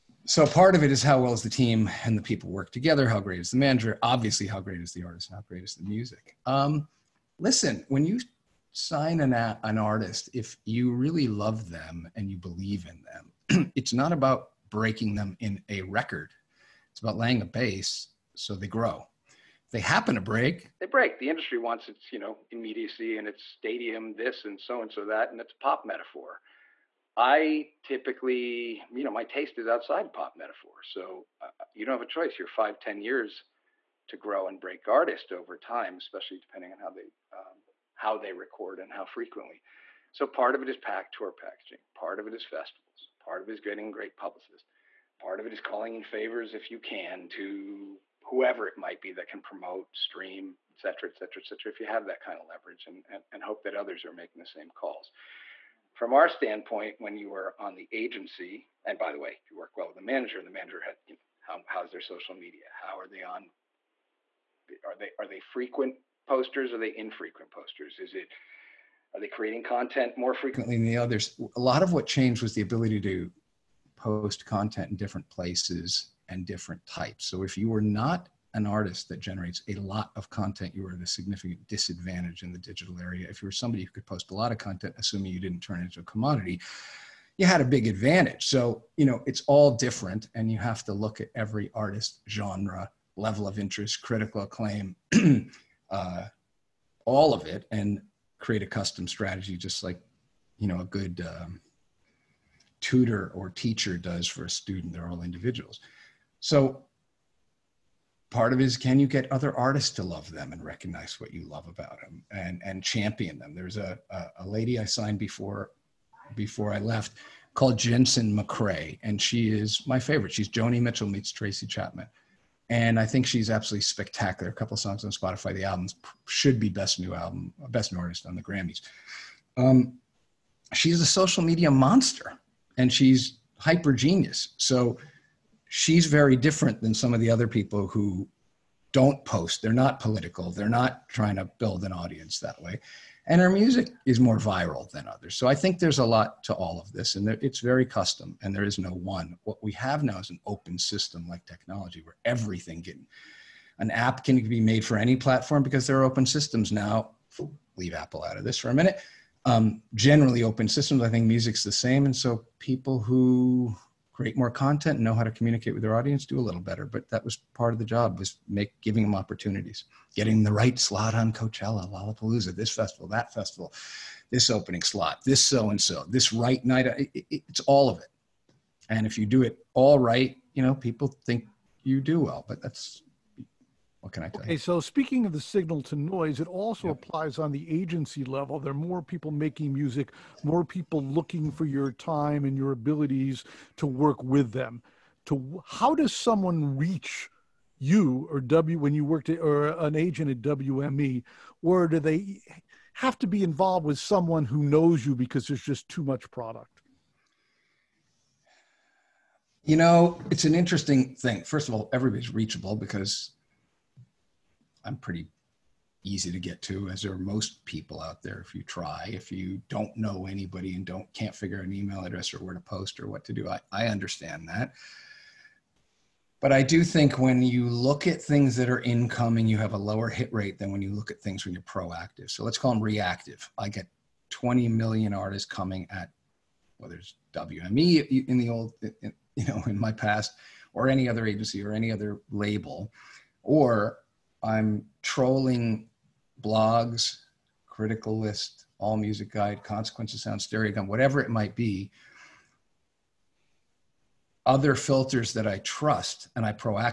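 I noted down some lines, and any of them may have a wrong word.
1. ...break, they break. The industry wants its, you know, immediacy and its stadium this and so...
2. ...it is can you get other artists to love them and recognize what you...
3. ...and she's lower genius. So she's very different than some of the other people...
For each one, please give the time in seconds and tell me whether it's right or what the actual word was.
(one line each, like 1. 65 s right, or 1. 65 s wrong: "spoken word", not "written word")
1. 20 s right
2. 108 s right
3. 132 s wrong: "hyper", not "lower".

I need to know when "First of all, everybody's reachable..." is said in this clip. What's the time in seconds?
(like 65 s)
211 s.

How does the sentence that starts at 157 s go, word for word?
Leave Apple out of this for a minute um, generally open systems.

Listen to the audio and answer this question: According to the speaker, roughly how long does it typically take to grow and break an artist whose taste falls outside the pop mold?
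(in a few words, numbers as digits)
5 to 10 years.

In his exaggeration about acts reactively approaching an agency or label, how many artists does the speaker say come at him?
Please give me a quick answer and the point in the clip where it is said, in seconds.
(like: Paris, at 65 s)
20 million, at 234 s.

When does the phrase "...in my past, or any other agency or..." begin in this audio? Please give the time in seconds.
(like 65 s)
239 s.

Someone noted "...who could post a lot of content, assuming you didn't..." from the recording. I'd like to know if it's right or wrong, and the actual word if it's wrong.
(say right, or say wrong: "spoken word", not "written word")
right.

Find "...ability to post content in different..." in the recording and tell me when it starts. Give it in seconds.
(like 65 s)
72 s.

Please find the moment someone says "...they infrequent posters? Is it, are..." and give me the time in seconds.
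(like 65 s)
66 s.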